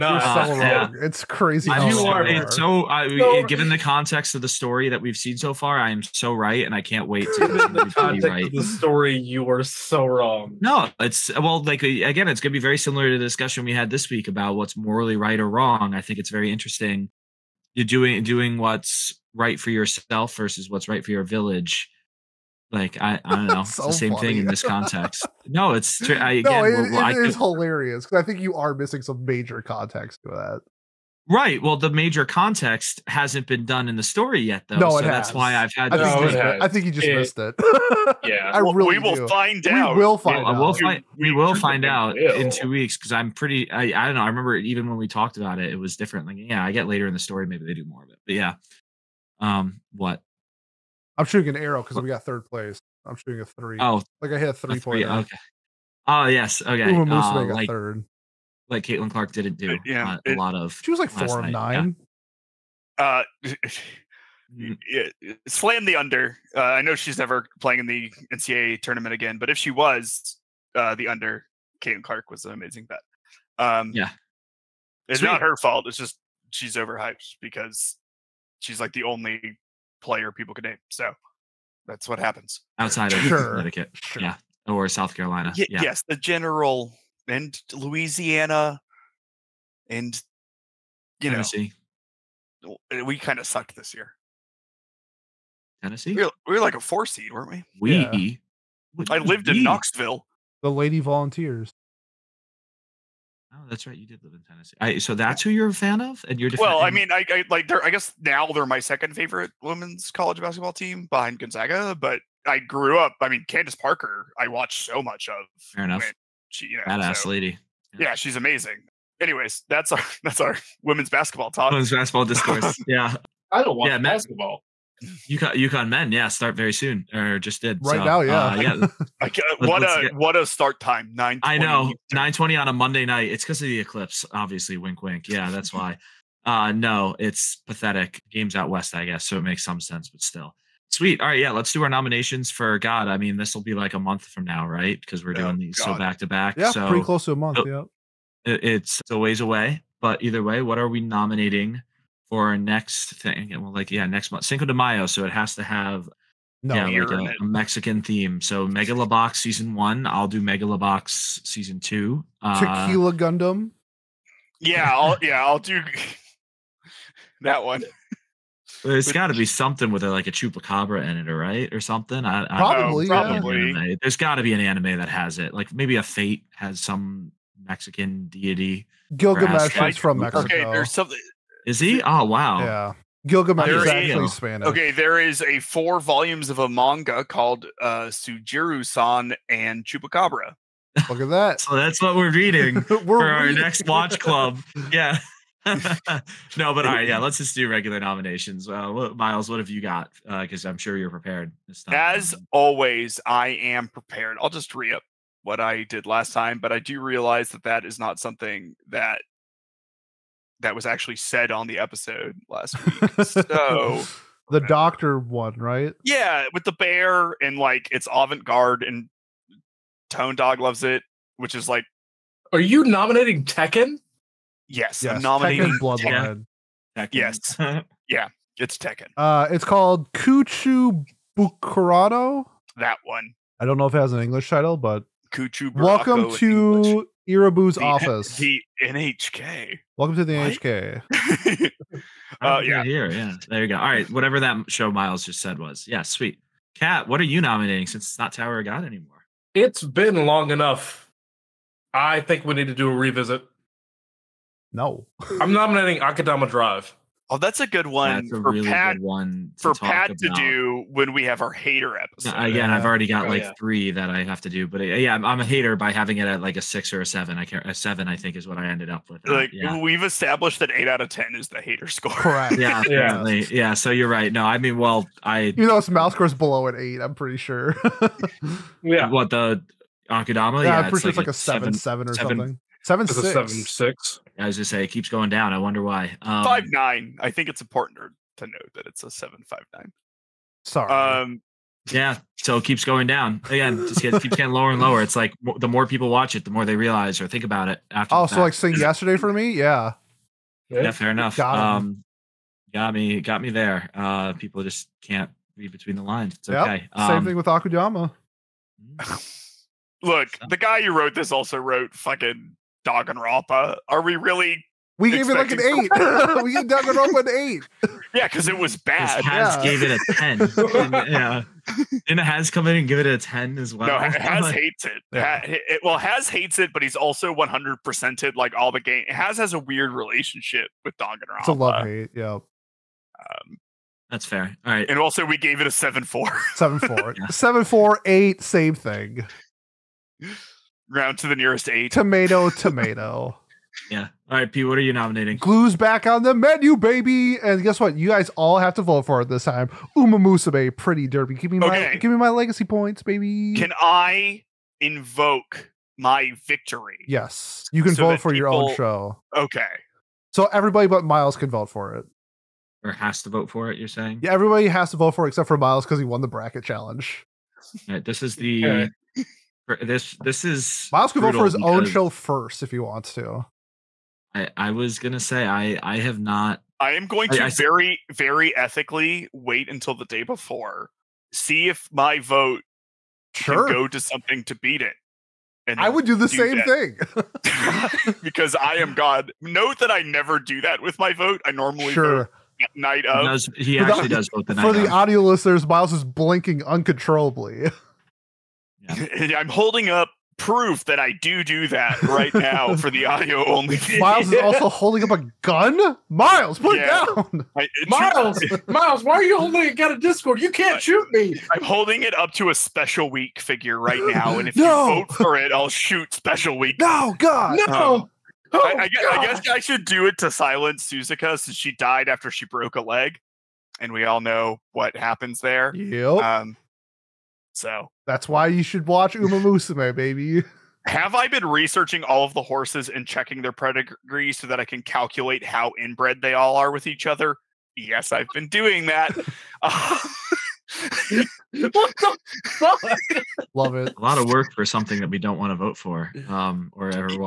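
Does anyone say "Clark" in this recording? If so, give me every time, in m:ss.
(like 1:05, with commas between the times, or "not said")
0:59, 1:12.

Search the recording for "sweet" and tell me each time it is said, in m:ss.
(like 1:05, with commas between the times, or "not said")
1:15, 2:20, 4:06.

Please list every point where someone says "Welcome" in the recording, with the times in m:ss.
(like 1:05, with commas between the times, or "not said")
3:55, 3:59.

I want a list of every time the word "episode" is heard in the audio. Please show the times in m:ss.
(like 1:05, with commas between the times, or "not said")
3:31, 4:21.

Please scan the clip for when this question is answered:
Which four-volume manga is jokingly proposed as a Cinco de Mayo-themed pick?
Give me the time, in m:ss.
3:08.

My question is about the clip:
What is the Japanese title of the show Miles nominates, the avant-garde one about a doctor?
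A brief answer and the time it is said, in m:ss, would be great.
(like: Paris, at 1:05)
Kuchu Buranko, at 3:50.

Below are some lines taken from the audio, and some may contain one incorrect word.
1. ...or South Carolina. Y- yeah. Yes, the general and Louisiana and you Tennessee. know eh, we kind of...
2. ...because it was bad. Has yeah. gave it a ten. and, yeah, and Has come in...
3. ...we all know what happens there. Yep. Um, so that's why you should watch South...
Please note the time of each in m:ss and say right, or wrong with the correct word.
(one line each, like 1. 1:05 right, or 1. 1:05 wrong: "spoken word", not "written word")
1. 1:24 right
2. 5:18 right
3. 7:03 wrong: "Uma", not "South".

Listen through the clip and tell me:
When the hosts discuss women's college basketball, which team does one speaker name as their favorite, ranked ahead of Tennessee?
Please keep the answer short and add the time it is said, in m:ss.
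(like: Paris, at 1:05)
Gonzaga, at 1:51.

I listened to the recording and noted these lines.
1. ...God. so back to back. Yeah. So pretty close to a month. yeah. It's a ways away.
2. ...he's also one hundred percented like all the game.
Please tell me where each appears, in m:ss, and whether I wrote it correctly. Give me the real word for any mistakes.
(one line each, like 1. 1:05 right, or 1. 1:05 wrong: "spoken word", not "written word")
1. 2:25 right
2. 5:26 right.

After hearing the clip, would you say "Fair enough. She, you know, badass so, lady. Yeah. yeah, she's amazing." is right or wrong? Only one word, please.
right.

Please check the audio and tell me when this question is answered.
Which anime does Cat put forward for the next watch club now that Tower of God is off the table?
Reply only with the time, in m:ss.
4:16.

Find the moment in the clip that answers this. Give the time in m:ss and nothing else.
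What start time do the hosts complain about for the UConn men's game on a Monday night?
2:12.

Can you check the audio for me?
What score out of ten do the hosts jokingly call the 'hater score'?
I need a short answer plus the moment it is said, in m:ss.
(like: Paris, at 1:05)
8, at 4:30.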